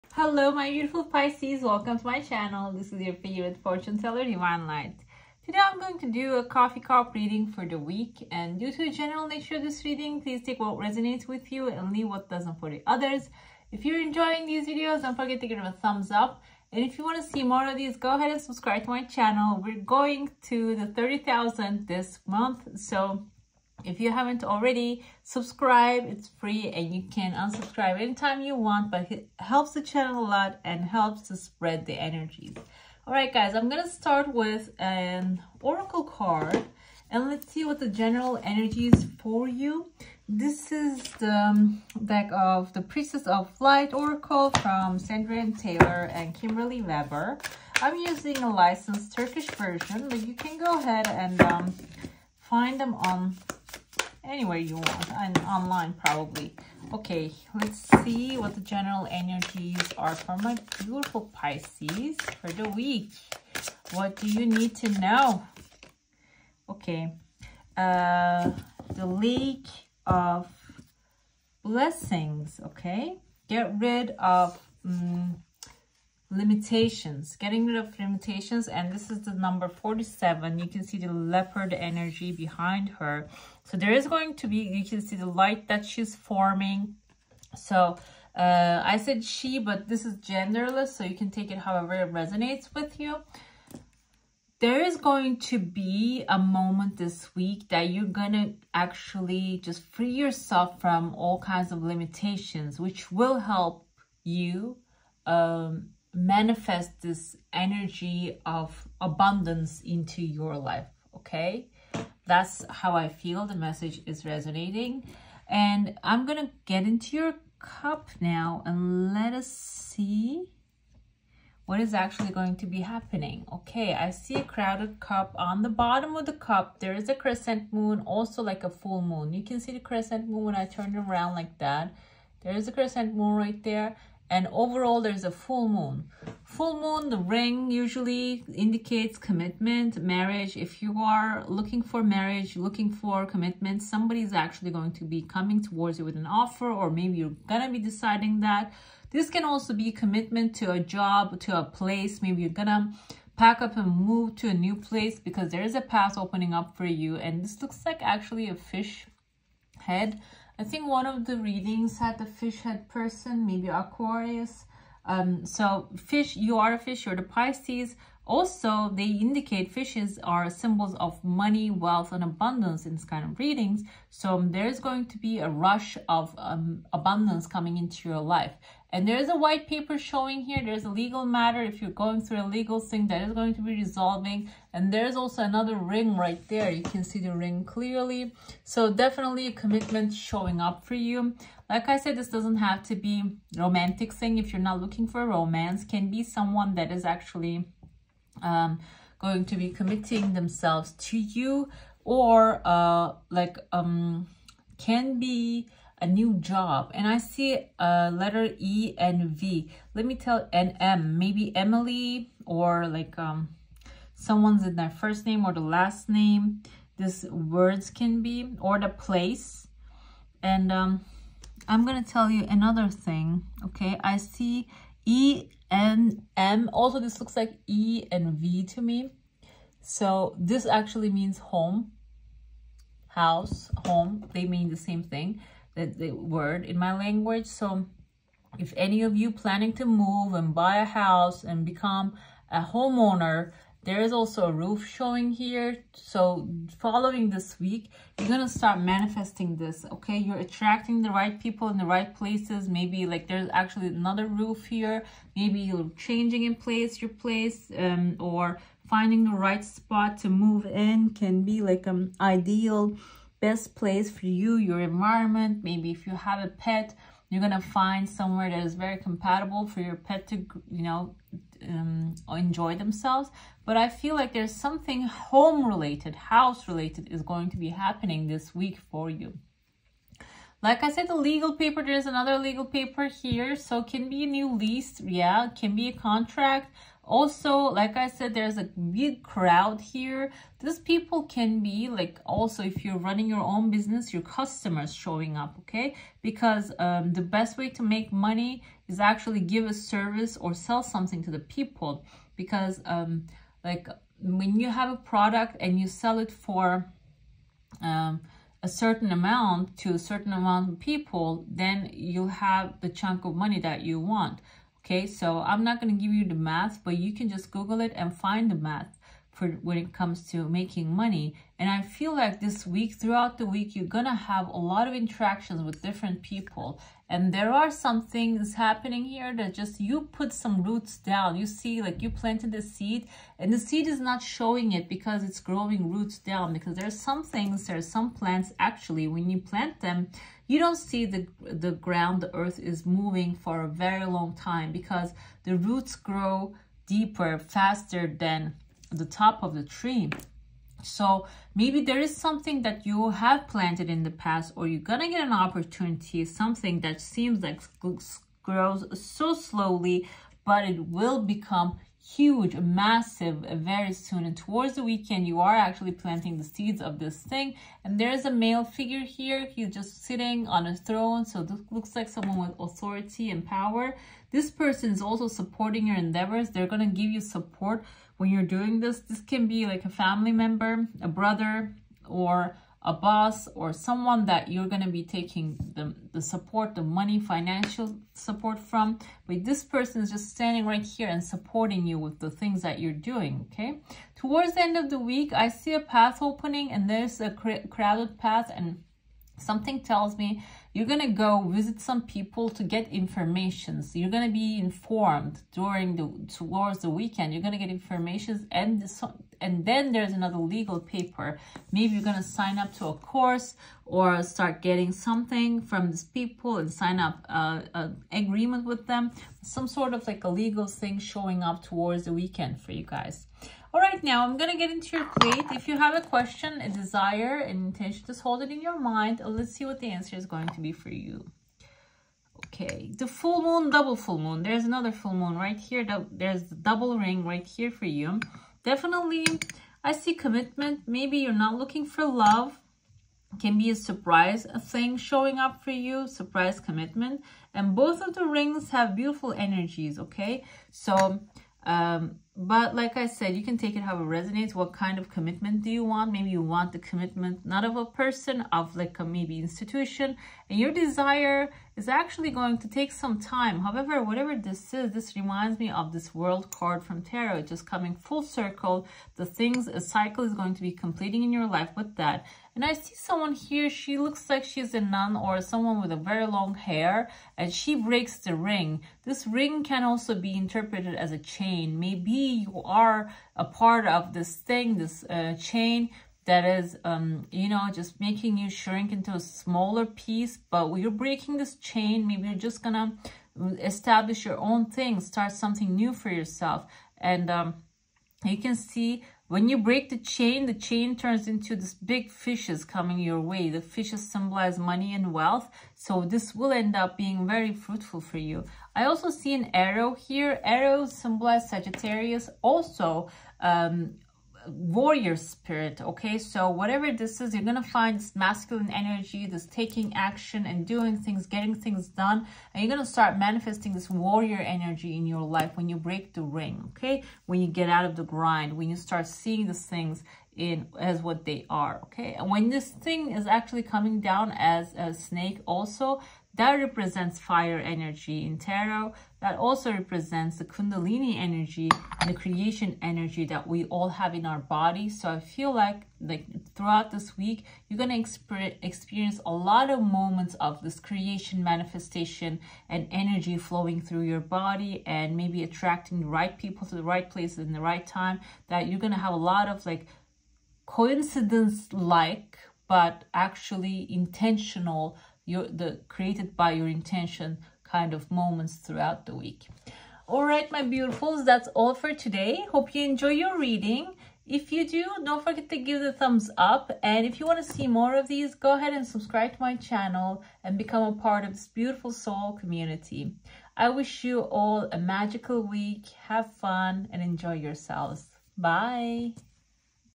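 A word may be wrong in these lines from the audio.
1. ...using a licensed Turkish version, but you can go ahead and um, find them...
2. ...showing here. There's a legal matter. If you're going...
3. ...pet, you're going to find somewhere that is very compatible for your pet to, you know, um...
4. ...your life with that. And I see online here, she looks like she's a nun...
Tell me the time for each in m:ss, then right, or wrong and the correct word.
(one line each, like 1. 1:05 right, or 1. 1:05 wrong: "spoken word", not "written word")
1. 0:47 right
2. 2:59 right
3. 4:26 right
4. 7:51 wrong: "someone", not "online".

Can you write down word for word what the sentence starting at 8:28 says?
I also see an arrow here.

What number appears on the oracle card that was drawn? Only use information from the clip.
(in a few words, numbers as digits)
47.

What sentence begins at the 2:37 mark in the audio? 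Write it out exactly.
And this looks like actually a fish head I think one of the readings had the fish head person, maybe Aquarius.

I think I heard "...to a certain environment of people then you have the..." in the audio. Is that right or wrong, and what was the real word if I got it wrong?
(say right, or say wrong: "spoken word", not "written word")
wrong: "amount", not "environment".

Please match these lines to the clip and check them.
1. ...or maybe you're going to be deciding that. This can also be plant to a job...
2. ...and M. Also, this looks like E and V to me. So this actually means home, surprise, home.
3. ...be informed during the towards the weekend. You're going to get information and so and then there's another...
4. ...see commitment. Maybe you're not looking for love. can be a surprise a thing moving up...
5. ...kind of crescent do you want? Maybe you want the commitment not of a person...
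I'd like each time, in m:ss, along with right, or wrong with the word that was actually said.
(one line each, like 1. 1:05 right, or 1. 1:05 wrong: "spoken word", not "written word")
1. 2:26 wrong: "commitment", not "plant"
2. 3:45 wrong: "house", not "surprise"
3. 6:44 right
4. 7:19 wrong: "showing", not "moving"
5. 7:34 wrong: "commitment", not "crescent".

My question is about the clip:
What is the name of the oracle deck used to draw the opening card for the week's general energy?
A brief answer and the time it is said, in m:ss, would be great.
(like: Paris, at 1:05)
Priestess of Light Oracle, at 0:42.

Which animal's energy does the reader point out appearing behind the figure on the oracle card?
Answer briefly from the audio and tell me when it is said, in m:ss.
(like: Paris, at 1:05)
Leopard, at 1:21.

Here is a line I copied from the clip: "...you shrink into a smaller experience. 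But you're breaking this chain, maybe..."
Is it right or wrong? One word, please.
wrong.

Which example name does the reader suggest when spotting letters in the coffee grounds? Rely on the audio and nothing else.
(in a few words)
Emily.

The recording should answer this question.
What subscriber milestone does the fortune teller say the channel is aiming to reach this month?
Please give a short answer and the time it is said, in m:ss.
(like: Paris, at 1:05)
30,000, at 0:20.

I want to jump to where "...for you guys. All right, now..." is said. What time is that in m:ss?
7:02.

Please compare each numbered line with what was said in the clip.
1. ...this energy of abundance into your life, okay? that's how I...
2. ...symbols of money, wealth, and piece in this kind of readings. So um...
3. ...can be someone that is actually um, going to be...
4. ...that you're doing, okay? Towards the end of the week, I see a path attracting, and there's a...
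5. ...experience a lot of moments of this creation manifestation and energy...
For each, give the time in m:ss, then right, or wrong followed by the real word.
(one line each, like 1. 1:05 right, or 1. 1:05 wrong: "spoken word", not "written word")
1. 1:47 right
2. 2:50 wrong: "abundance", not "piece"
3. 3:15 right
4. 6:32 wrong: "opening", not "attracting"
5. 9:08 right.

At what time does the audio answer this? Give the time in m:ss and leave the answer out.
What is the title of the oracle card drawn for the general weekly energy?
1:08.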